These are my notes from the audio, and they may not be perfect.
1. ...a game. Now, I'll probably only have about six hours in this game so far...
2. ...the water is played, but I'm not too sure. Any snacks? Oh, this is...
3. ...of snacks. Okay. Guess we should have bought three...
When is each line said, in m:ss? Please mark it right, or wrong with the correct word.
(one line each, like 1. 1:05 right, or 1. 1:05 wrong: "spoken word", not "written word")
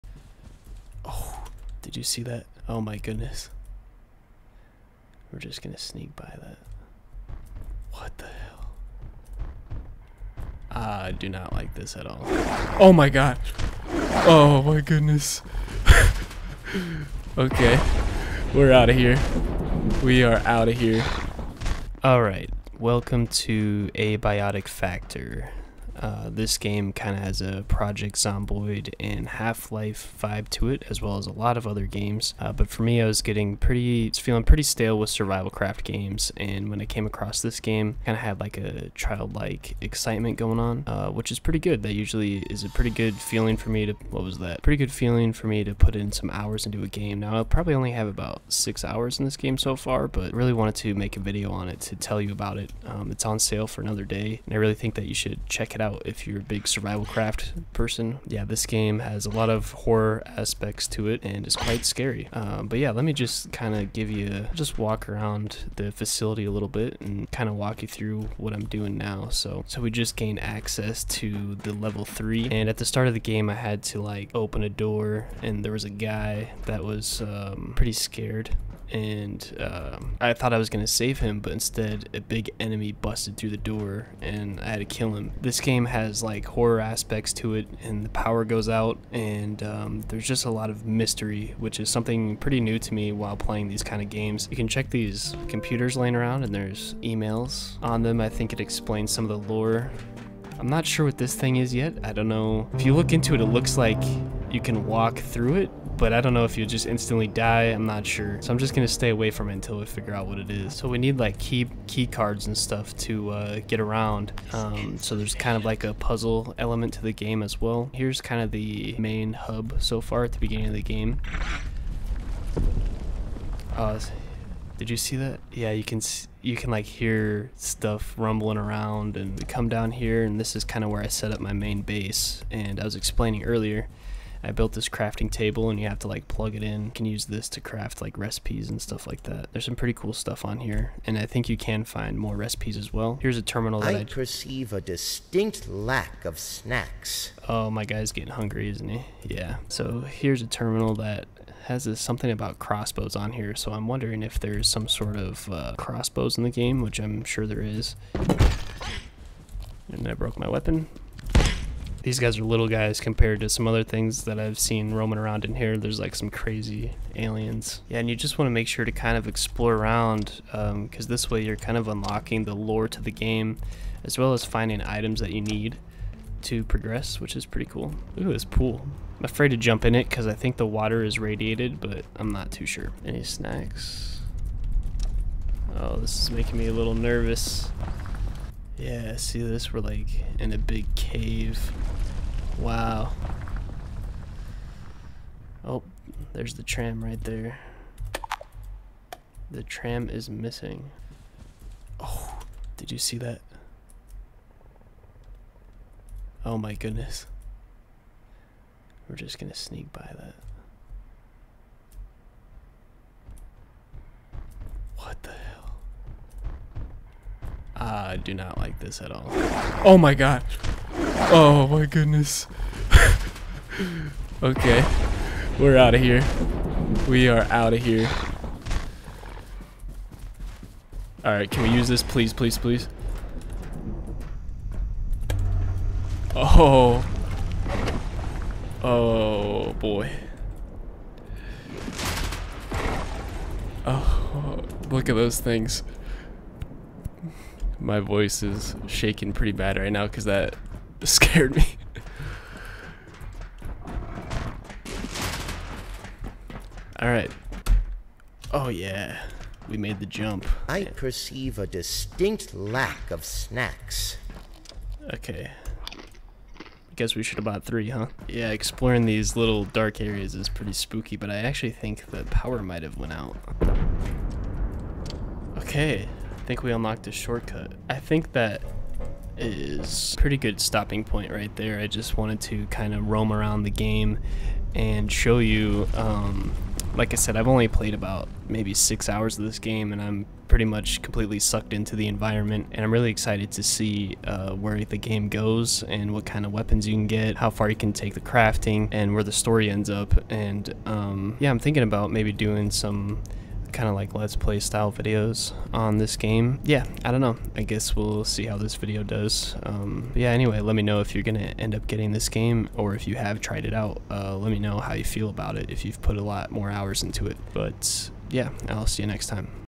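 1. 0:46 right
2. 3:00 wrong: "radiated", not "played"
3. 4:23 right.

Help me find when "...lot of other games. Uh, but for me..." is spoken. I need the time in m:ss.
0:31.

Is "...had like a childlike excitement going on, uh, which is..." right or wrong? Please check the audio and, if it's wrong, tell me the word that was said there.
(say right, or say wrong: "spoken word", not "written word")
right.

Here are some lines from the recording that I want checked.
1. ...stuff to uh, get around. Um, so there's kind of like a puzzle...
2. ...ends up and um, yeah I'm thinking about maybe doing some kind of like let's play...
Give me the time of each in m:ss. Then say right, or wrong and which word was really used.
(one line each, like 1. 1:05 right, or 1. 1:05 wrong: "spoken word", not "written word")
1. 1:52 right
2. 4:59 right.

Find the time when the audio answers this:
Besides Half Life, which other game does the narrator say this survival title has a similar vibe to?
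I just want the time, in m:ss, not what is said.
0:27.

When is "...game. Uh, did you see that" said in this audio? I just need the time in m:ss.
2:00.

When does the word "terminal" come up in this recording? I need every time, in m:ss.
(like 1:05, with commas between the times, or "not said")
2:23, 2:30.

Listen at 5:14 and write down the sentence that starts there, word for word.
Uh, let me know how you feel about it if you've put a lot more hours into it.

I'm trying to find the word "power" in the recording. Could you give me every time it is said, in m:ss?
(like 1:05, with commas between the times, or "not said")
1:28, 4:32.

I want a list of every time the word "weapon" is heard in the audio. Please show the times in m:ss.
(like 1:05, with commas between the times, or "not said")
2:40, 4:56.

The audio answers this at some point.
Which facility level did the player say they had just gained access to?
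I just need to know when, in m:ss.
1:11.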